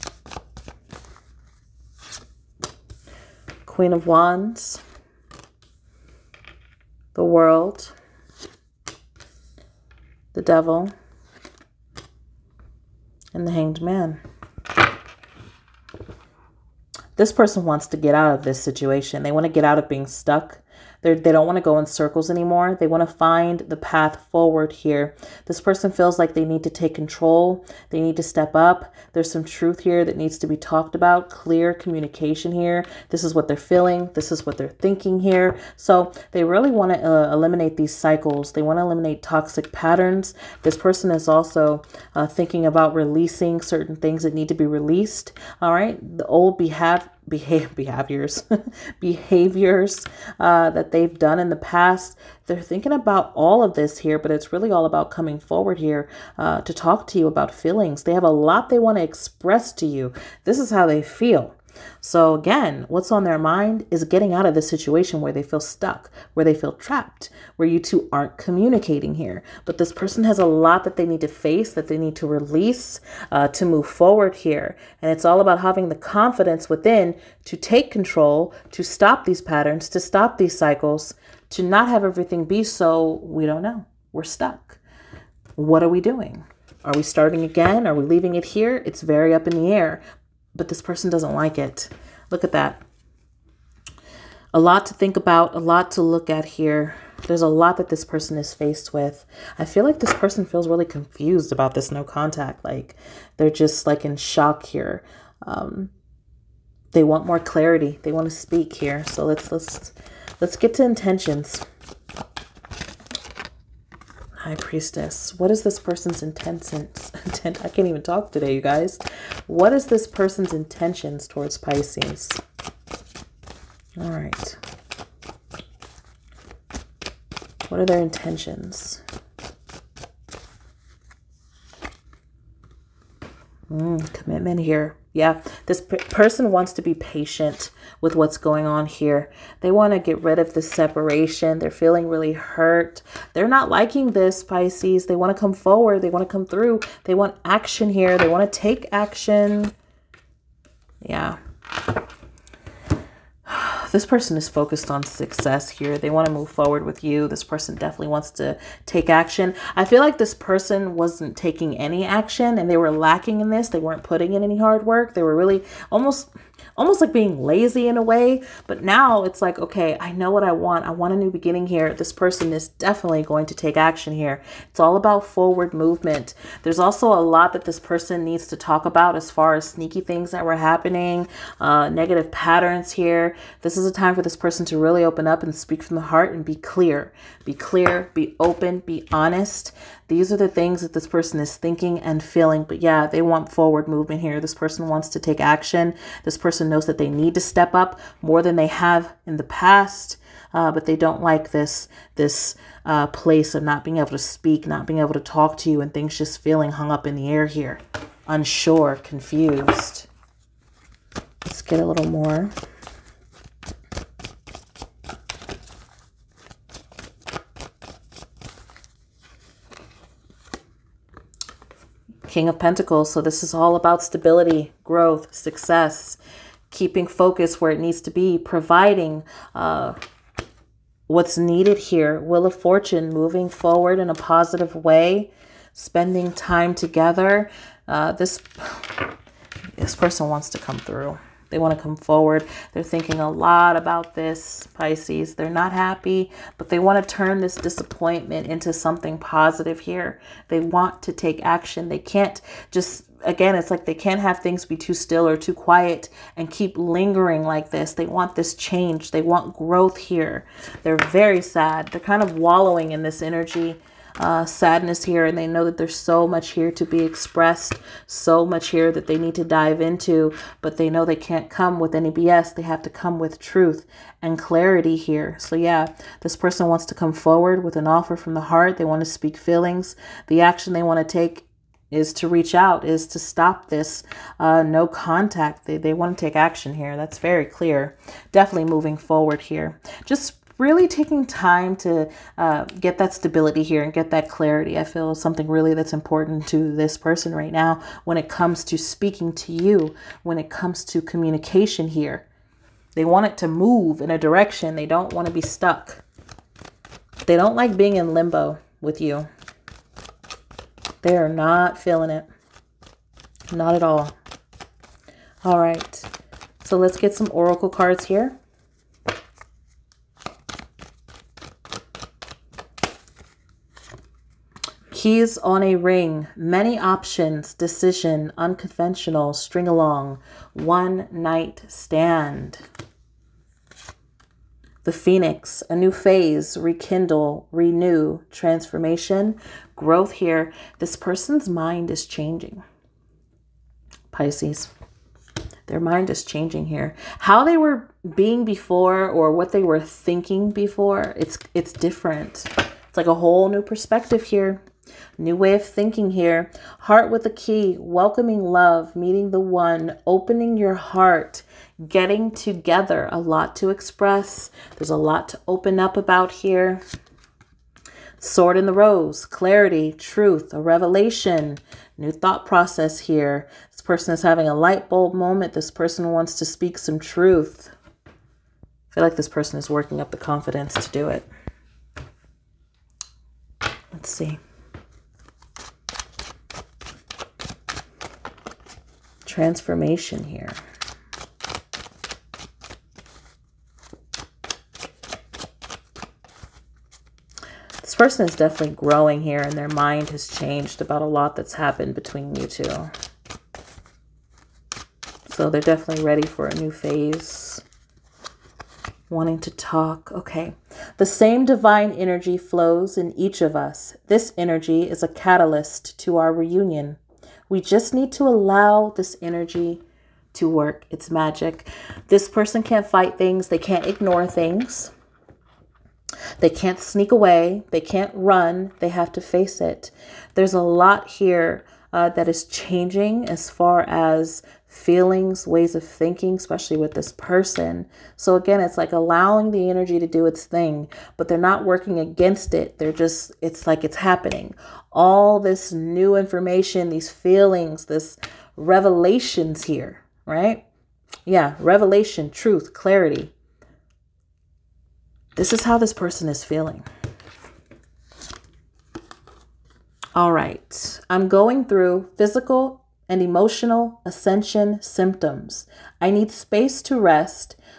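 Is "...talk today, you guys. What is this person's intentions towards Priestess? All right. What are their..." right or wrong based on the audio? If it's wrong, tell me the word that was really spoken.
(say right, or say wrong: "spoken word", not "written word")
wrong: "Pisces", not "Priestess".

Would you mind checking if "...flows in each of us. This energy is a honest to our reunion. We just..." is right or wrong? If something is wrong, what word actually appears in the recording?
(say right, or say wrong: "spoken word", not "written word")
wrong: "catalyst", not "honest".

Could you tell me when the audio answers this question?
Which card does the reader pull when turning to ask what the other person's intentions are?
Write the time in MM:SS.
01:54.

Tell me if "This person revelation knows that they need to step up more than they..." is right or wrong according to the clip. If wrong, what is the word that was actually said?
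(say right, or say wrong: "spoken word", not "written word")
wrong: "person", not "revelation".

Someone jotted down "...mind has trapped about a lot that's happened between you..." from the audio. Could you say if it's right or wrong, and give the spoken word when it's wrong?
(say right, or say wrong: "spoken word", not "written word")
wrong: "changed", not "trapped".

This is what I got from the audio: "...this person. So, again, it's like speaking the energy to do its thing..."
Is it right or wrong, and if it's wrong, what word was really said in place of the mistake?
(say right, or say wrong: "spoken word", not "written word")
wrong: "allowing", not "speaking".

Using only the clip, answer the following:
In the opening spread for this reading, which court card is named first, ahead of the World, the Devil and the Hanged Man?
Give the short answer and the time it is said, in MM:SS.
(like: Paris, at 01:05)
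Queen of Wands, at 00:03.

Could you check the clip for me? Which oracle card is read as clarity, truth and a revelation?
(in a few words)
Sword in the rose.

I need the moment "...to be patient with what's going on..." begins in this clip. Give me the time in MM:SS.
02:16.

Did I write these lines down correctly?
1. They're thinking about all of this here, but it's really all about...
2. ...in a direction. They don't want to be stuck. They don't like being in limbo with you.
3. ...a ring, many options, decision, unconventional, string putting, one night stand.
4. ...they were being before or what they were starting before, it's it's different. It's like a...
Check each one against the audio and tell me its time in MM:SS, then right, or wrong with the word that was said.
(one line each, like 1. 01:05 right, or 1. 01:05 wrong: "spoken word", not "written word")
1. 00:52 right
2. 05:04 right
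3. 05:25 wrong: "along", not "putting"
4. 05:47 wrong: "thinking", not "starting".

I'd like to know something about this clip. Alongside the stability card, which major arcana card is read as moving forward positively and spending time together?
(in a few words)
Wheel of Fortune.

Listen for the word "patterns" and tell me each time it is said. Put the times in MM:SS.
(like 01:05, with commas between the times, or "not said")
00:39, 01:19, 03:02.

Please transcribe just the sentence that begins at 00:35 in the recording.
So they really want to uh, eliminate these cycles.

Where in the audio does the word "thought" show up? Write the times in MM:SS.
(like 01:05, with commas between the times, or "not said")
06:12.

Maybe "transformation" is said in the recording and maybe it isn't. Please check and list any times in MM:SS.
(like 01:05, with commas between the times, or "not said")
05:38, 06:29.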